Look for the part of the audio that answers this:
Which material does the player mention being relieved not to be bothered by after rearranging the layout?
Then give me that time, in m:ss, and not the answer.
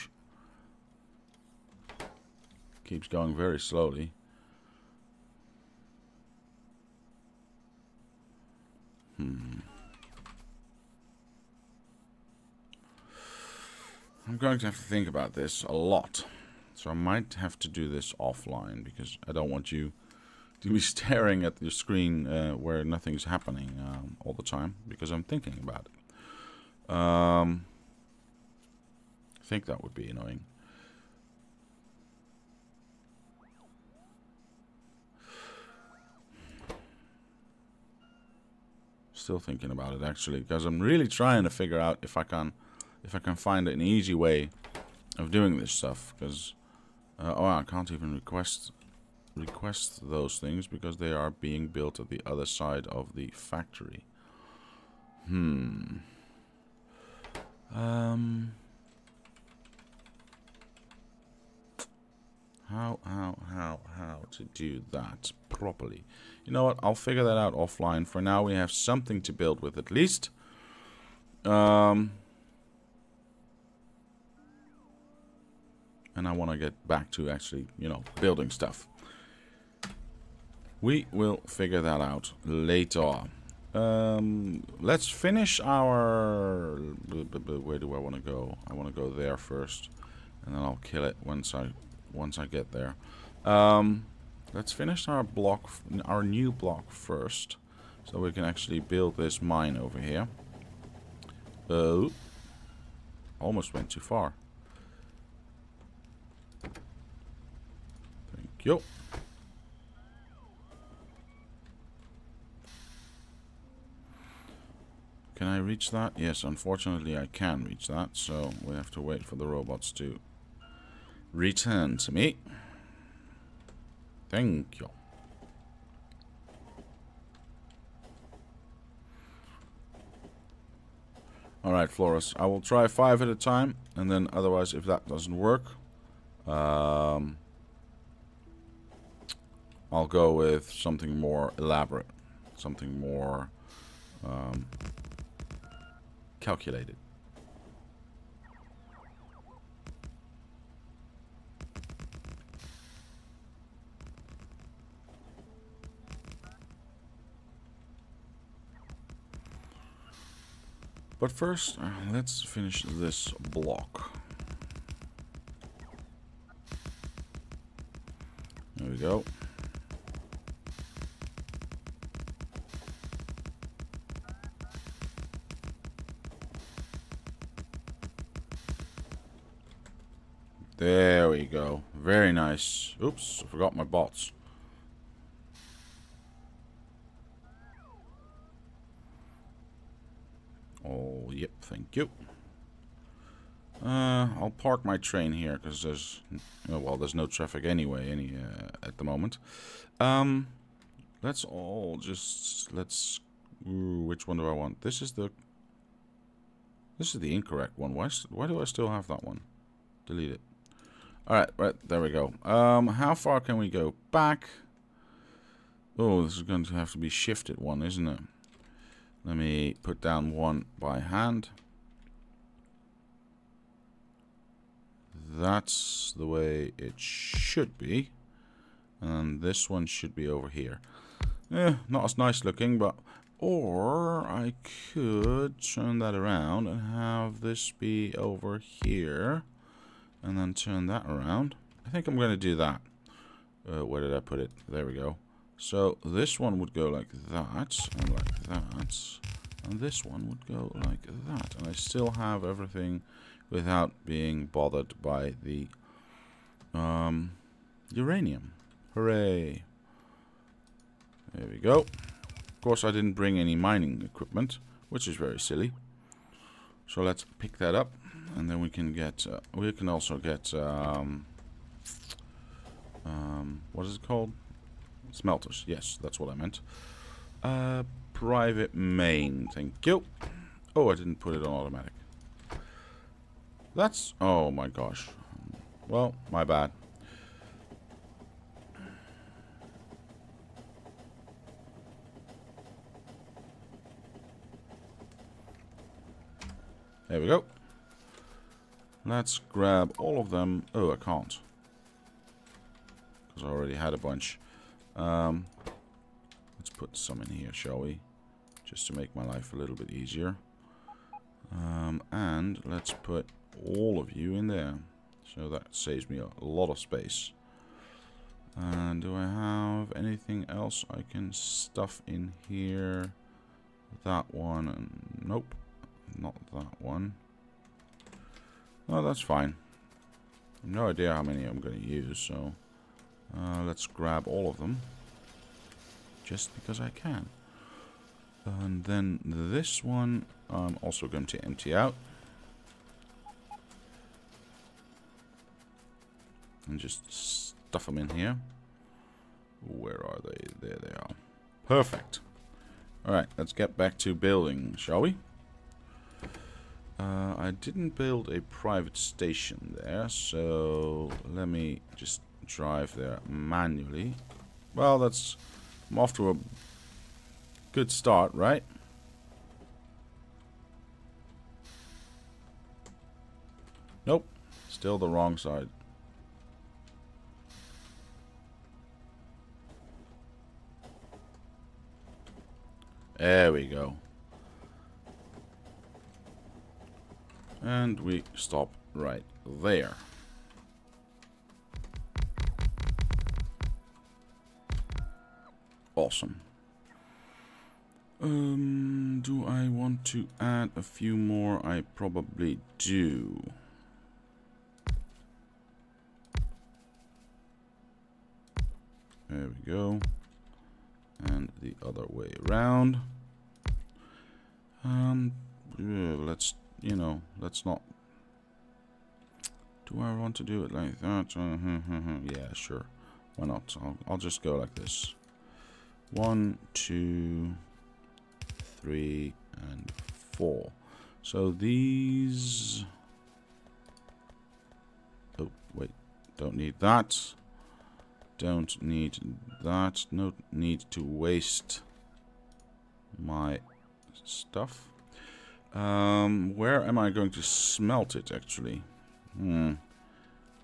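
4:17.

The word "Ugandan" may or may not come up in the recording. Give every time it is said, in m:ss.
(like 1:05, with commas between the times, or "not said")
not said.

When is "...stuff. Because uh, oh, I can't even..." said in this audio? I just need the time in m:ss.
0:45.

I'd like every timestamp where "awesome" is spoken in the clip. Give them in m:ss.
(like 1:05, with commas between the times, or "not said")
6:36.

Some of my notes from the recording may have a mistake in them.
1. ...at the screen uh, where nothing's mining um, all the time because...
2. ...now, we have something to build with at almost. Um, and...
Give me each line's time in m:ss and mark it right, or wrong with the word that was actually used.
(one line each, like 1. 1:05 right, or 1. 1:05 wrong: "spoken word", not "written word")
1. 0:21 wrong: "happening", not "mining"
2. 1:08 wrong: "least", not "almost".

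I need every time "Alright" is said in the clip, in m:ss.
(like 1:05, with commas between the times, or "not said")
2:11, 5:53.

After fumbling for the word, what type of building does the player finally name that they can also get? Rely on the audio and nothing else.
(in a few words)
smelters.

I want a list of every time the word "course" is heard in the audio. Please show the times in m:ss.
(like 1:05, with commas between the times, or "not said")
4:22.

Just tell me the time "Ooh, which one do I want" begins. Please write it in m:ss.
3:23.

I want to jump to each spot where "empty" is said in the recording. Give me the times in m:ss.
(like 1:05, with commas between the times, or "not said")
5:41.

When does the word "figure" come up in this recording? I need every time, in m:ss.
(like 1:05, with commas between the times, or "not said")
0:41, 1:06, 1:21.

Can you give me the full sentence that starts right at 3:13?
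Uh, I'll park my train here because there's, oh, well, there's no traffic anyway, any uh, at the moment.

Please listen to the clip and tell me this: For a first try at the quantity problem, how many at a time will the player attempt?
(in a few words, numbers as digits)
5.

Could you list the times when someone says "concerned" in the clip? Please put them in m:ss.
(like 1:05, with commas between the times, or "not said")
not said.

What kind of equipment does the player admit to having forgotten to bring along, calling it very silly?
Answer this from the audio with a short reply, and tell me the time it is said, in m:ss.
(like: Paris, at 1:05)
mining equipment, at 4:23.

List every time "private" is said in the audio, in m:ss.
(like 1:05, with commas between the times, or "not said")
4:38, 5:58.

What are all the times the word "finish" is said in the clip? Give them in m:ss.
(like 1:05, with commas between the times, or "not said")
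1:25, 1:34, 2:42.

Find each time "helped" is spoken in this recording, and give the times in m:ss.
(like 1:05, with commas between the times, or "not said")
not said.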